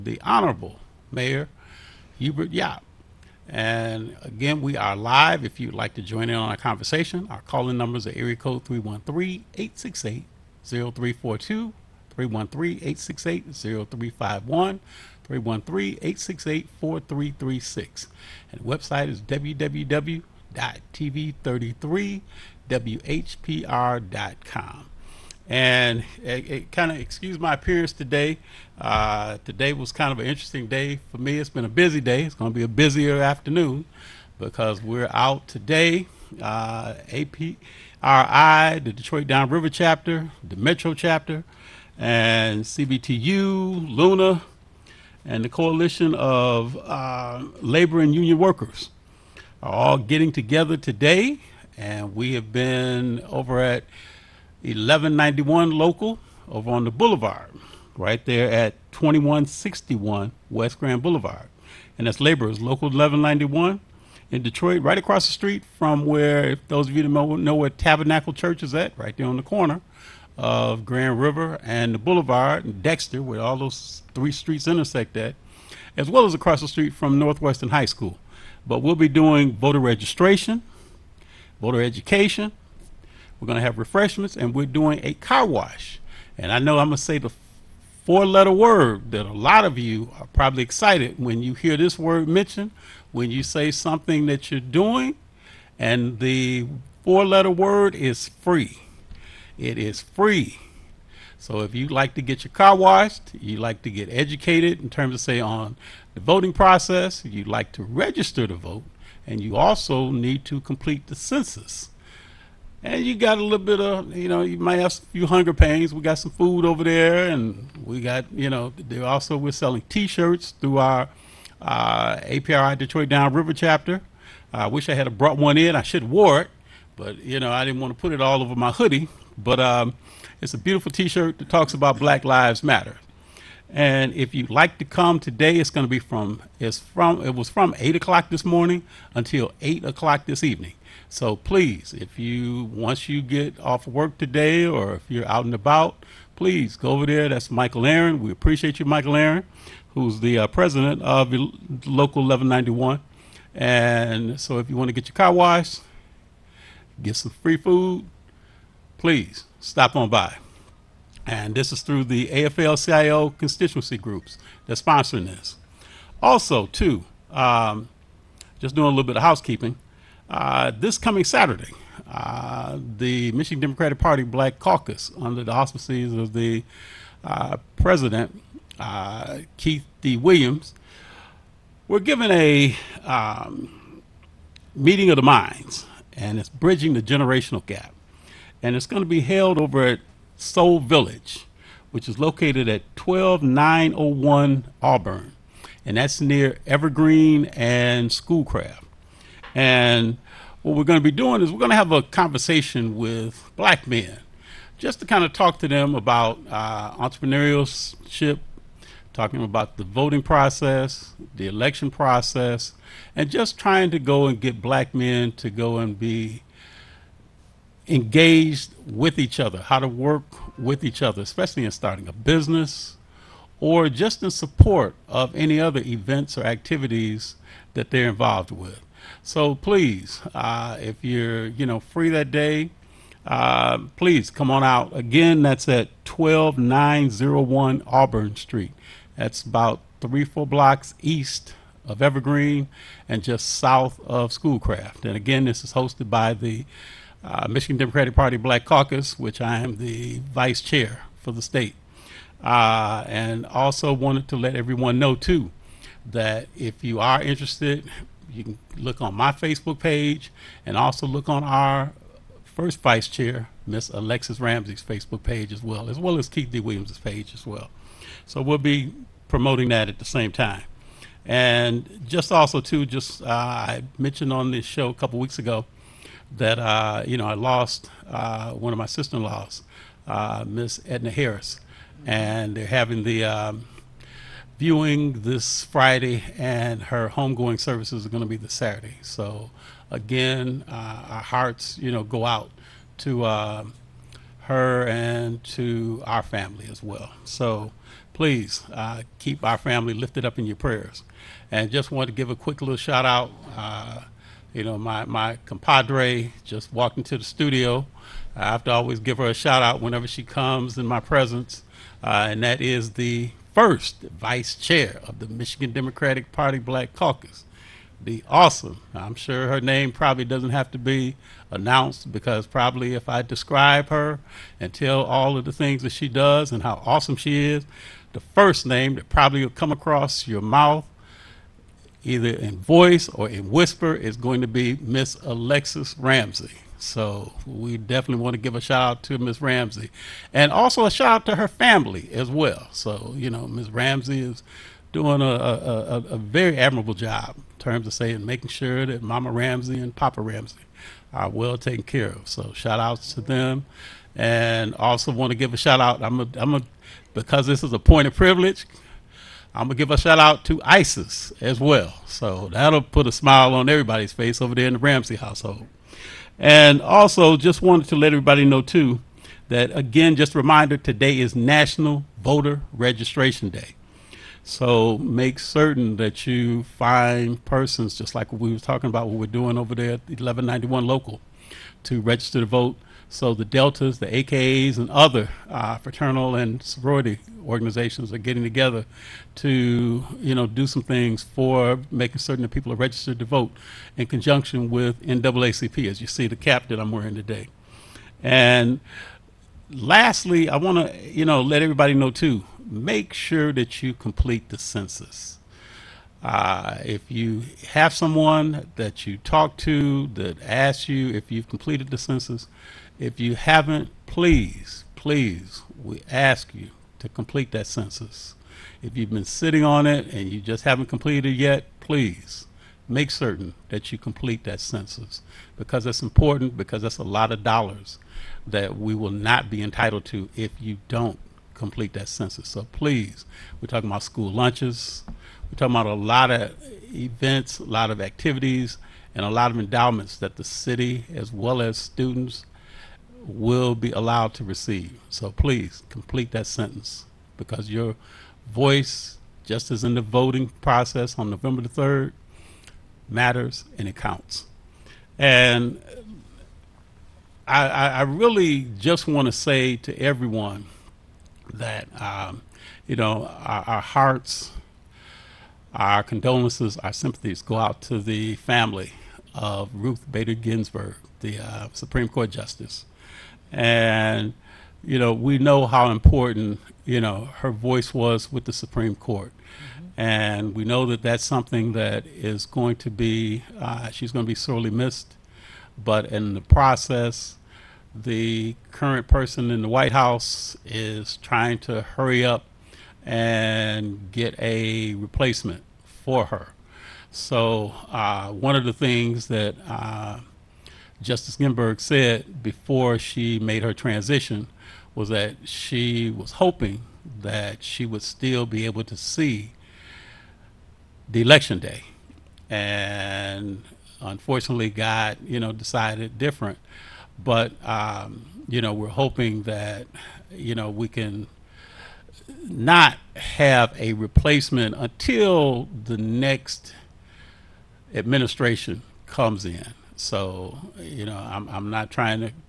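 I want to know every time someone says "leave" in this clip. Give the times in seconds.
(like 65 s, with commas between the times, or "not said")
not said.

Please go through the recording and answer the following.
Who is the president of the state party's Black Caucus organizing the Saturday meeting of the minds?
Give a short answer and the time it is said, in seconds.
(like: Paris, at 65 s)
Keith D. Williams, at 179 s.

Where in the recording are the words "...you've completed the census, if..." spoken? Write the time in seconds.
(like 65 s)
411 s.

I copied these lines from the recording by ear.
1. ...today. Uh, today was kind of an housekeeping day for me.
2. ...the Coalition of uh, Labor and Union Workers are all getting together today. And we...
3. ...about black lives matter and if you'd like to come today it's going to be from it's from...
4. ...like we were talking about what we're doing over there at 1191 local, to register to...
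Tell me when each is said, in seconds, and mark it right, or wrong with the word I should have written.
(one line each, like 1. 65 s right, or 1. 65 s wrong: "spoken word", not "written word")
1. 27 s wrong: "interesting", not "housekeeping"
2. 45 s right
3. 131 s right
4. 378 s right.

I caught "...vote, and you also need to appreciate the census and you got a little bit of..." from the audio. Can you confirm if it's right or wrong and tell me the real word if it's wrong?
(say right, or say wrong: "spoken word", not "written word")
wrong: "complete", not "appreciate".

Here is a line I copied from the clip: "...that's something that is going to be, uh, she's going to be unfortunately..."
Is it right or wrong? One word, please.
wrong.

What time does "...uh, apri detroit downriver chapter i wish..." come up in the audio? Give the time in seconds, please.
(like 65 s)
121 s.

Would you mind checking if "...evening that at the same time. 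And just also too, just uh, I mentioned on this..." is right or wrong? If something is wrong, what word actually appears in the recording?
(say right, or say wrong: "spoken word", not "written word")
wrong: "promoting", not "evening".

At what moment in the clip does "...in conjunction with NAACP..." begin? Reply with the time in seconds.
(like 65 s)
393 s.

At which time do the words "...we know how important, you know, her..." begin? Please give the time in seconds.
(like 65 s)
475 s.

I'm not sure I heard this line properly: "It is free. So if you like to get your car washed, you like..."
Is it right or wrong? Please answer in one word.
right.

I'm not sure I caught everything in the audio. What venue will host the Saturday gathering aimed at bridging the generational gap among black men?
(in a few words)
Soul Village.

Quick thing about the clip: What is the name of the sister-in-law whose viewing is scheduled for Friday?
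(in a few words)
Edna Harris.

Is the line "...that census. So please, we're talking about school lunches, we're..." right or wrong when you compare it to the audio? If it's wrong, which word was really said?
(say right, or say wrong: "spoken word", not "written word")
right.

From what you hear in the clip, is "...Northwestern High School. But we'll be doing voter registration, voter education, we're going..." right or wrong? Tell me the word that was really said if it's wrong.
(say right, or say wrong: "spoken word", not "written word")
right.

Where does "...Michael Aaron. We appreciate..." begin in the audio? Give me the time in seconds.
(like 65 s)
147 s.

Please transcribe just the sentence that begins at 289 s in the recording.
So, again, uh, our hearts, you know, go out to uh, her and to our family as well.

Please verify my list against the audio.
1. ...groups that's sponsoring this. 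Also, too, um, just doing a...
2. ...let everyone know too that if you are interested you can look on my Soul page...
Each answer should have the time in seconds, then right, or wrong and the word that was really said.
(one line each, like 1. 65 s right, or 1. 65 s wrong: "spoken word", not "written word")
1. 163 s right
2. 254 s wrong: "Facebook", not "Soul".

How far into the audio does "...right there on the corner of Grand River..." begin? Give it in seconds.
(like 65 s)
68 s.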